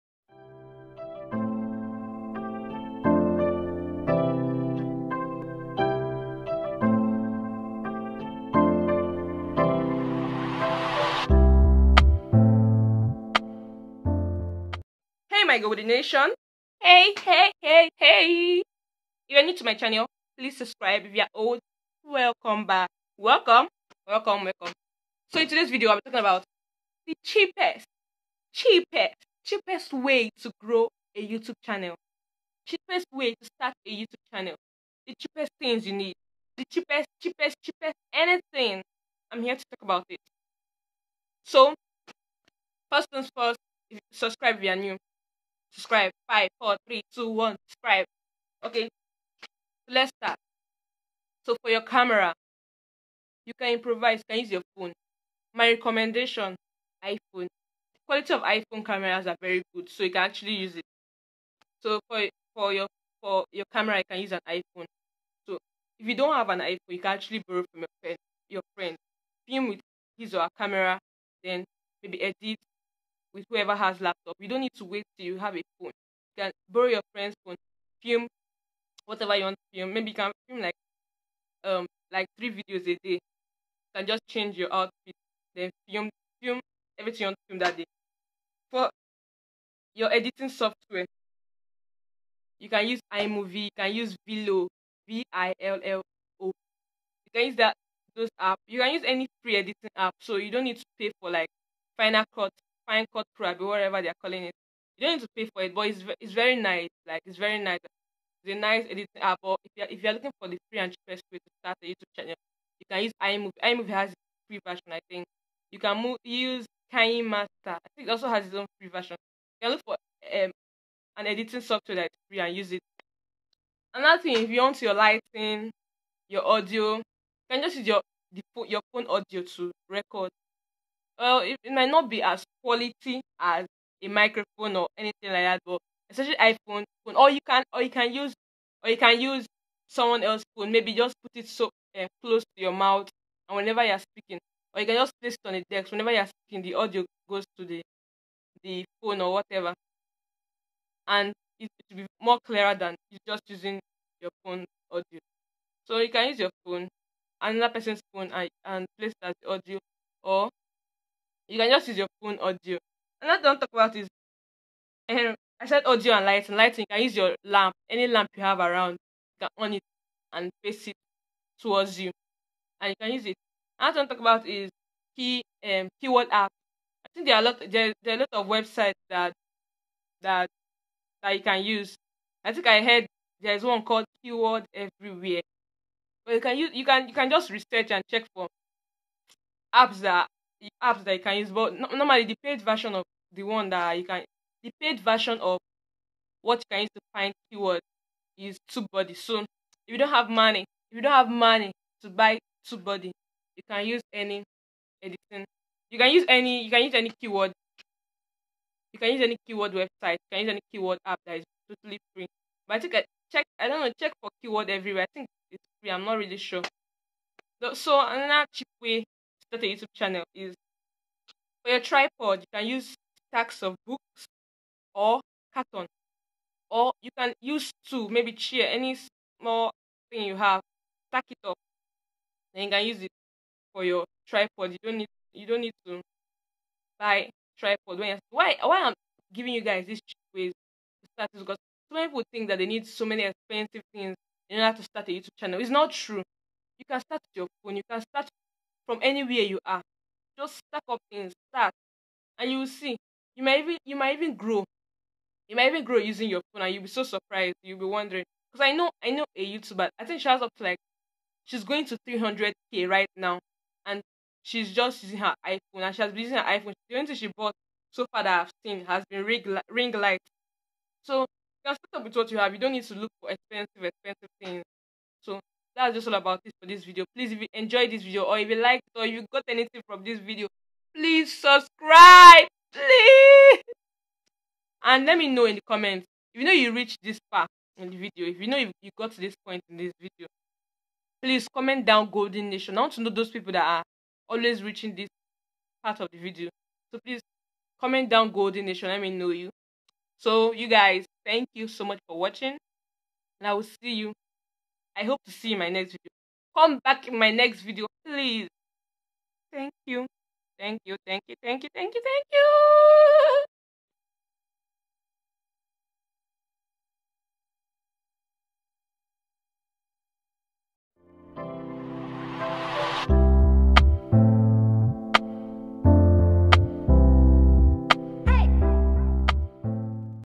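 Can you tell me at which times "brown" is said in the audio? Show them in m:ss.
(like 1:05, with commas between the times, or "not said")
not said.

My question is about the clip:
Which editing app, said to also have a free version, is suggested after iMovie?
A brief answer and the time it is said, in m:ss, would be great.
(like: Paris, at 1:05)
KineMaster, at 1:56.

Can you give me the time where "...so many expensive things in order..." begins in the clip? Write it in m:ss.
4:02.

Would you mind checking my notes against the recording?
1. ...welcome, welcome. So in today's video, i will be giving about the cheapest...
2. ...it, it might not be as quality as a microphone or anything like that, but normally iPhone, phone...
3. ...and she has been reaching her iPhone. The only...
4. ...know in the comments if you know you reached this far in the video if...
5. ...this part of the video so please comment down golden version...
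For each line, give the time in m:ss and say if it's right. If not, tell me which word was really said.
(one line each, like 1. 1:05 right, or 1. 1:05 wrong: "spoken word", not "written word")
1. 0:24 wrong: "talking", not "giving"
2. 2:11 wrong: "especially", not "normally"
3. 4:25 wrong: "using", not "reaching"
4. 4:45 right
5. 4:54 wrong: "nation", not "version".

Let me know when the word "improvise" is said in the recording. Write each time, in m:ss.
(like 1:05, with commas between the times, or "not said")
0:53.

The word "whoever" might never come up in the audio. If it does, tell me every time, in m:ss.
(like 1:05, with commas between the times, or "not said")
1:13.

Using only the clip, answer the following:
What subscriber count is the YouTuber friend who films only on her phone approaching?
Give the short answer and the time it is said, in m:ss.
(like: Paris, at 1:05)
300k, at 4:22.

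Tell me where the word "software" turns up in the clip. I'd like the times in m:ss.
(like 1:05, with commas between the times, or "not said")
1:30, 2:01.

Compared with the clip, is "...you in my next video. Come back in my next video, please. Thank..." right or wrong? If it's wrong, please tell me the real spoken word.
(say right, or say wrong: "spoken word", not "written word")
right.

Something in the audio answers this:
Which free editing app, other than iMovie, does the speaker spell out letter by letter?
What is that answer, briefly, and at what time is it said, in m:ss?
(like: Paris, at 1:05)
Vilo, at 1:34.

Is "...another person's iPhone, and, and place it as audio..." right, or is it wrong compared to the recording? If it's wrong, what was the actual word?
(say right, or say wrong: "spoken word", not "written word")
wrong: "phone", not "iPhone".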